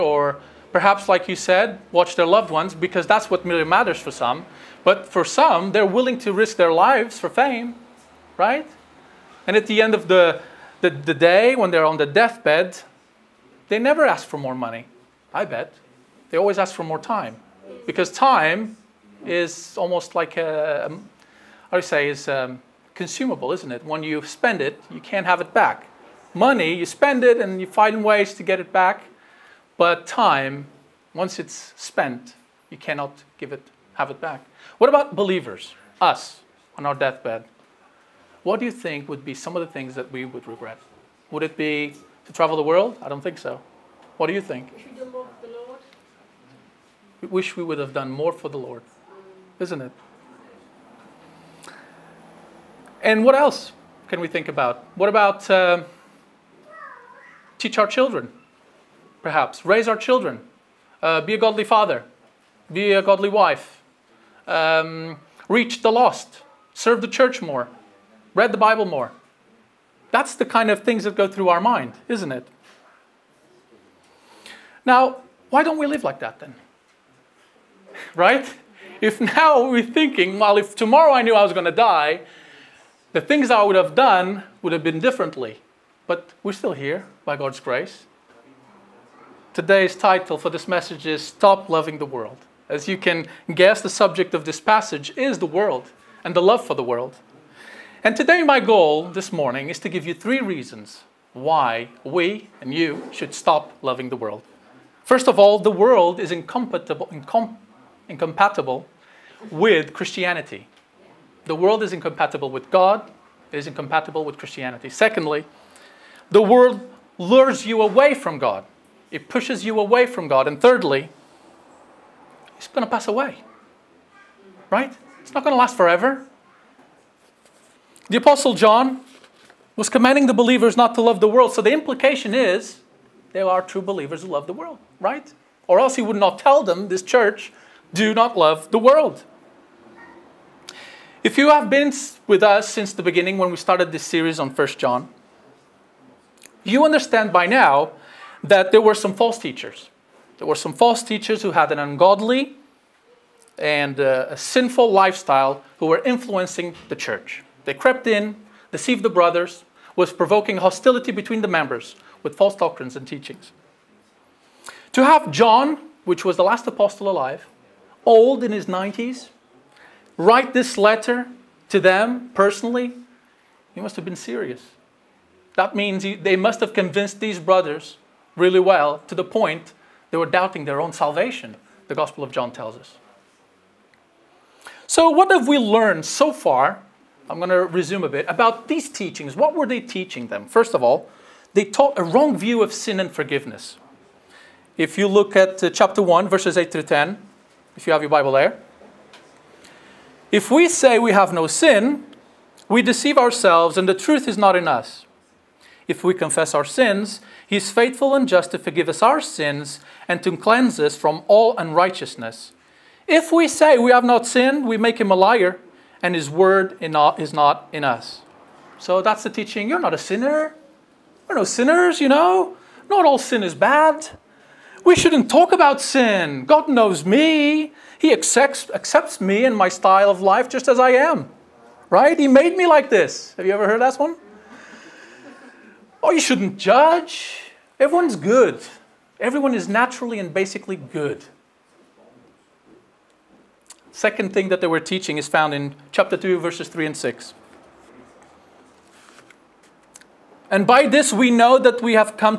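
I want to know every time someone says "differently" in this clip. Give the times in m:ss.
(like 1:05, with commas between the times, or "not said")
1:25.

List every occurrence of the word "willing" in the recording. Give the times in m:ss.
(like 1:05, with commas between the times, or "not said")
0:05.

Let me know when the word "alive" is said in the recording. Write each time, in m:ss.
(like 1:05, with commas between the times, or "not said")
2:47.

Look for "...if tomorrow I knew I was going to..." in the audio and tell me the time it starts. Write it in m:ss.
1:20.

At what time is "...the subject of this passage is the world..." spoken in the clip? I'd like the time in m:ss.
1:33.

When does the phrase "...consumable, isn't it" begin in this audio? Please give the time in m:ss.
0:22.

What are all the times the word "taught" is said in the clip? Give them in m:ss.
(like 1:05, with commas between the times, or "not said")
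3:11.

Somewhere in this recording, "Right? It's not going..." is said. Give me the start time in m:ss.
2:04.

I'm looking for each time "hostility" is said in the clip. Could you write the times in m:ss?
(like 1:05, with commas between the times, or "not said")
2:40.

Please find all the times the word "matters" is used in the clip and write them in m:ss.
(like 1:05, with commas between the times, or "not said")
0:03.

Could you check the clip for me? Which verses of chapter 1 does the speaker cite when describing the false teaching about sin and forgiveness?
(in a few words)
Verses 8 through 10.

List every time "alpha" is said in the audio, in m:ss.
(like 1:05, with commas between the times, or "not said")
not said.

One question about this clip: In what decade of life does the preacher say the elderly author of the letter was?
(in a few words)
His 90s.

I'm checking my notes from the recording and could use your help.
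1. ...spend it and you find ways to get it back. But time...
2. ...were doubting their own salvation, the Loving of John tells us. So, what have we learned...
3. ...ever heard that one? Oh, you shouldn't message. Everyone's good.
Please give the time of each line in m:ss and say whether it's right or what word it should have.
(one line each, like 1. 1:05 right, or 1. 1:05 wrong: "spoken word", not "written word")
1. 0:26 right
2. 3:00 wrong: "Gospel", not "Loving"
3. 3:53 wrong: "judge", not "message".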